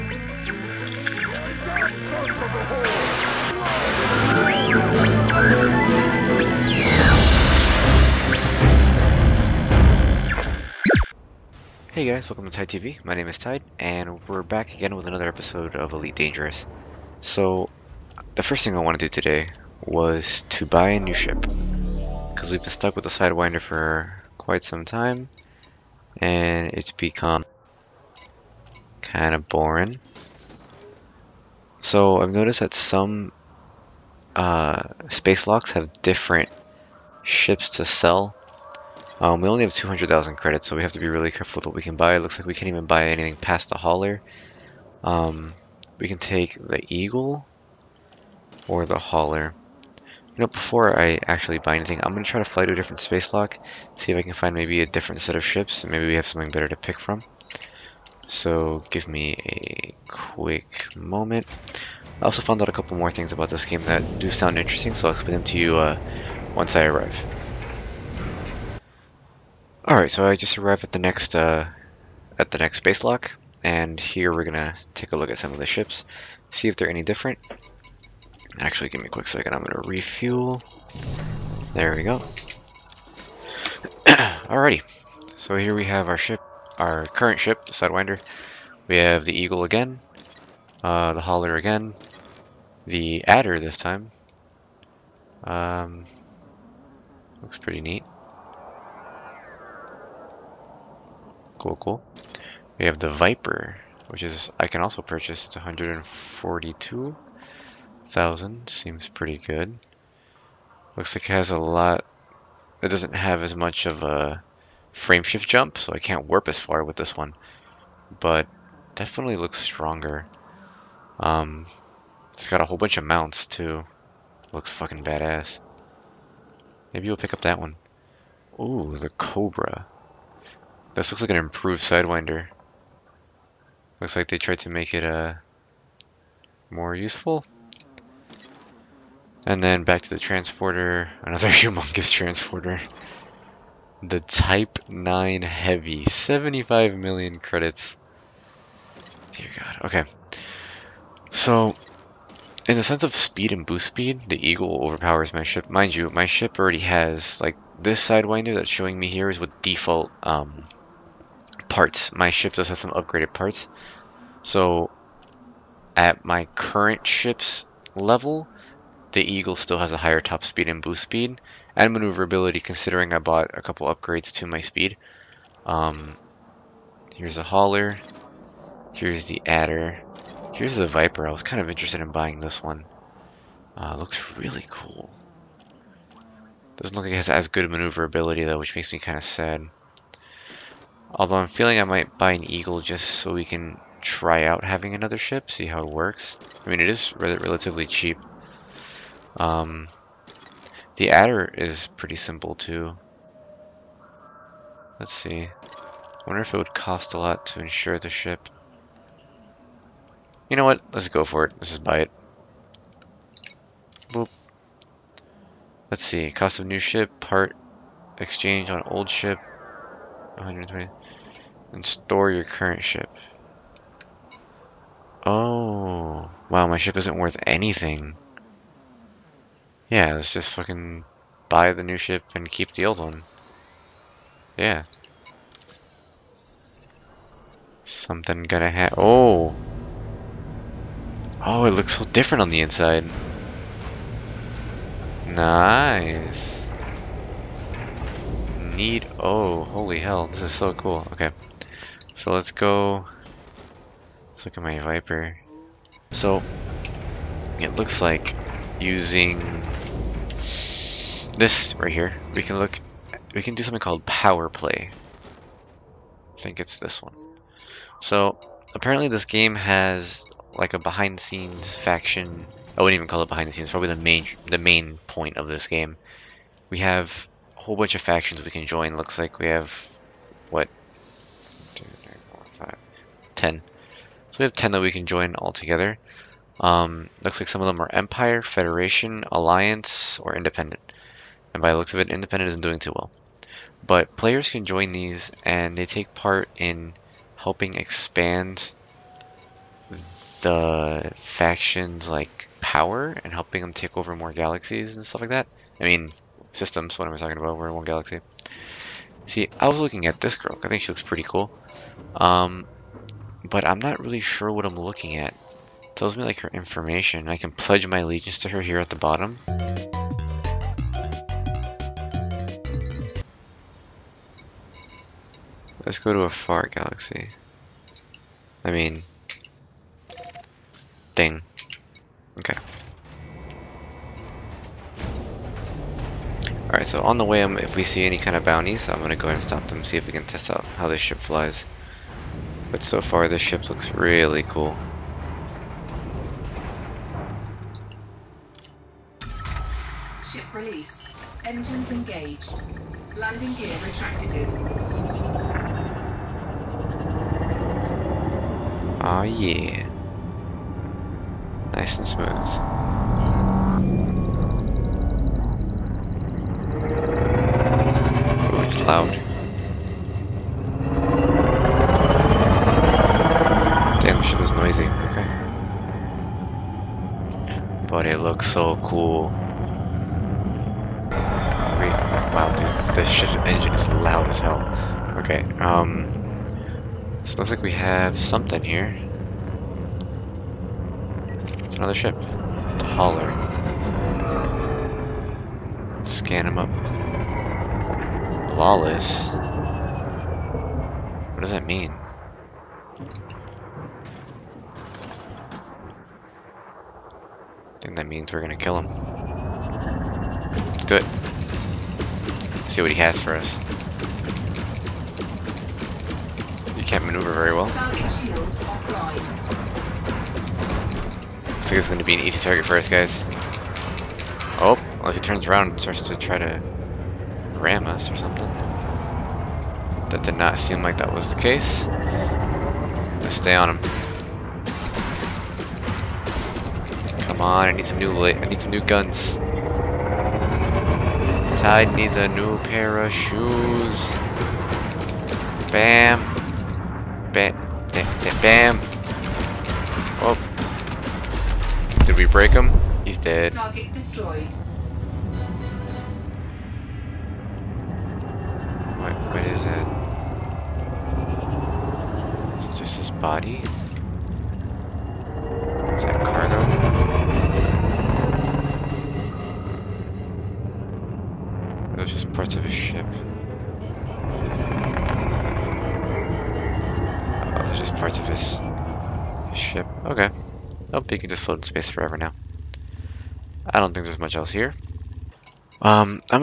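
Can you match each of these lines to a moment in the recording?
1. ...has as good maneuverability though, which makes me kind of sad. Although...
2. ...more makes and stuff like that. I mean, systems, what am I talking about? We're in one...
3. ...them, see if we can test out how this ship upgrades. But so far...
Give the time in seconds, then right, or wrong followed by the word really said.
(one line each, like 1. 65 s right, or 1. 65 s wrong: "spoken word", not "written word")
1. 187 s right
2. 304 s wrong: "galaxies", not "makes"
3. 339 s wrong: "flies", not "upgrades".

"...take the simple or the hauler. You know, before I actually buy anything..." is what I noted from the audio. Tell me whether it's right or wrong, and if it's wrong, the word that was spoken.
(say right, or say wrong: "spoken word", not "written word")
wrong: "eagle", not "simple".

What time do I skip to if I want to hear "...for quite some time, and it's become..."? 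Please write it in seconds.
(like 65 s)
23 s.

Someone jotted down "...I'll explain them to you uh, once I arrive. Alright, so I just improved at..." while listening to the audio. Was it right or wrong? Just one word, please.
wrong.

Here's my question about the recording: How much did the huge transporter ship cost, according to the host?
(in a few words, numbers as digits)
75 million credits.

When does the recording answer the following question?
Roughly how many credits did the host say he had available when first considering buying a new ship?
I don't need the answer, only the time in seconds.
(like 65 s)
39 s.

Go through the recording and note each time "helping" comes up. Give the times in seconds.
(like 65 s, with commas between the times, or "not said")
297 s, 303 s.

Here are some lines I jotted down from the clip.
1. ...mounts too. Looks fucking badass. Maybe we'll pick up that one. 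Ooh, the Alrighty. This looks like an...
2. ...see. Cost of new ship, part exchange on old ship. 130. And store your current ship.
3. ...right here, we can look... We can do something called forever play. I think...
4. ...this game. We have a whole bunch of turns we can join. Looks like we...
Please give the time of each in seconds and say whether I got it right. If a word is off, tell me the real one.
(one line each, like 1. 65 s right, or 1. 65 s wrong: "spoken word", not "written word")
1. 123 s wrong: "Cobra", not "Alrighty"
2. 216 s wrong: "120", not "130"
3. 261 s wrong: "power", not "forever"
4. 275 s wrong: "factions", not "turns".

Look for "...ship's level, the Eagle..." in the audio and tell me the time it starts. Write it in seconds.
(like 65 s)
167 s.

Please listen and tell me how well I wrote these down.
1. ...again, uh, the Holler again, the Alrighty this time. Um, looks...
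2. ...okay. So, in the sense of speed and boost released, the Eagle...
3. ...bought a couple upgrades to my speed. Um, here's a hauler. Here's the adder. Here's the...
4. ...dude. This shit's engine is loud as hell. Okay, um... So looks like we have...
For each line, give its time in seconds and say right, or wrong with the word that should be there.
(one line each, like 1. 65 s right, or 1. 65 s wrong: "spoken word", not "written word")
1. 89 s wrong: "Adder", not "Alrighty"
2. 149 s wrong: "speed", not "released"
3. 173 s right
4. 382 s right.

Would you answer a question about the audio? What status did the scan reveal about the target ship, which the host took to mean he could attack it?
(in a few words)
Lawless.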